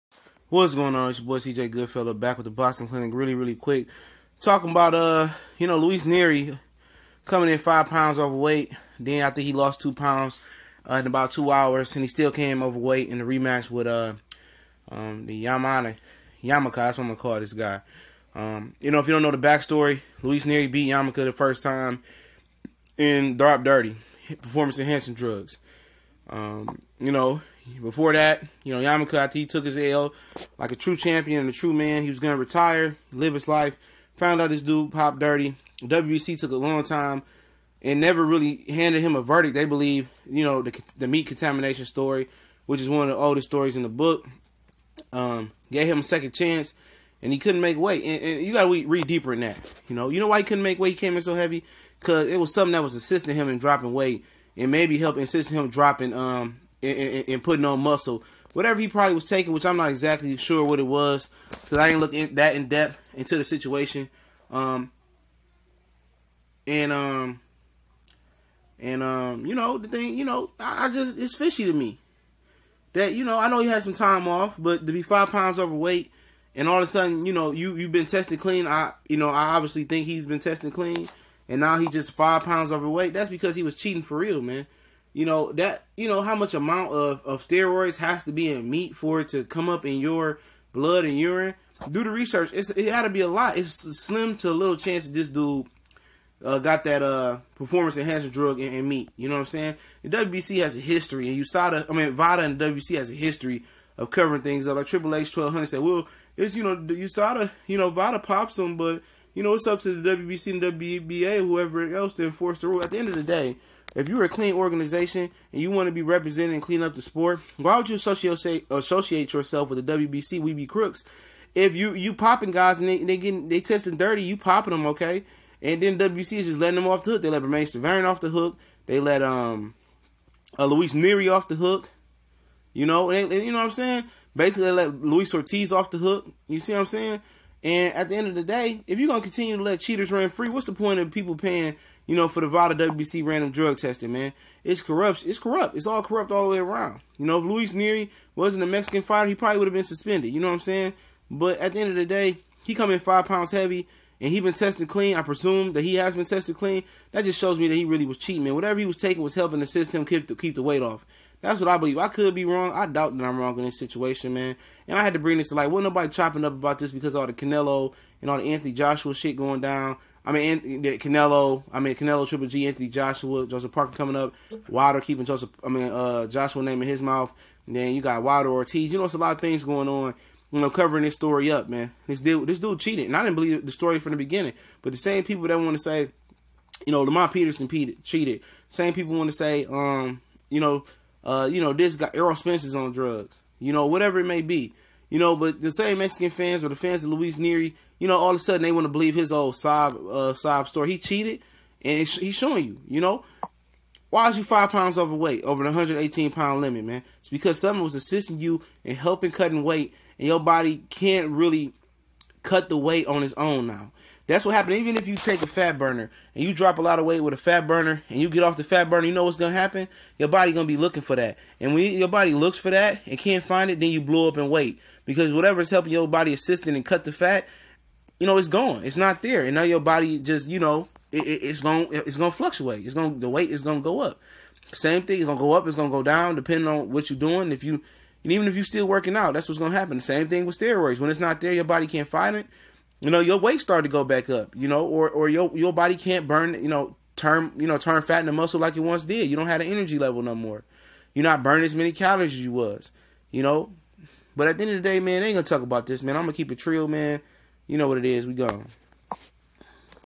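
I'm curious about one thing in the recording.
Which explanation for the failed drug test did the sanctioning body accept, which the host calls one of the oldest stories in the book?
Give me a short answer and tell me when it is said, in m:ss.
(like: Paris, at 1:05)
meat contamination, at 0:41.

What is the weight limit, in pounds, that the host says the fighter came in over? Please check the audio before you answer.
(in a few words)
118.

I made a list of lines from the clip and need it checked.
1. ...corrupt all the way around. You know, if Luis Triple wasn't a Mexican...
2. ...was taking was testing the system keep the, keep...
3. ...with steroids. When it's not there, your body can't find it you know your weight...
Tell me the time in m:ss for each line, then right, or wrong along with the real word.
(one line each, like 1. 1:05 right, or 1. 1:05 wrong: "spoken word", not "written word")
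1. 2:26 wrong: "Nery", not "Triple"
2. 2:38 wrong: "helping", not "testing"
3. 4:00 right.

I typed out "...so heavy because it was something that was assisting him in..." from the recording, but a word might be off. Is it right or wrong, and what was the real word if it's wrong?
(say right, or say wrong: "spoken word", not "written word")
right.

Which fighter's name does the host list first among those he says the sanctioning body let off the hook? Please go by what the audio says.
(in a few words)
Romain Severin.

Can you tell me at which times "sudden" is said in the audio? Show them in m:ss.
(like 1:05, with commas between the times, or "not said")
1:16, 3:18.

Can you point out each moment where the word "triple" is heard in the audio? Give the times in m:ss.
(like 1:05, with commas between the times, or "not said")
1:44, 2:52.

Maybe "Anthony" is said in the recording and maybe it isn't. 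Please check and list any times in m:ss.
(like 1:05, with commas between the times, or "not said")
2:48, 2:52.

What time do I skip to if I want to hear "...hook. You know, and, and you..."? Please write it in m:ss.
2:11.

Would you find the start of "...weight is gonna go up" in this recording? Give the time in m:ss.
3:53.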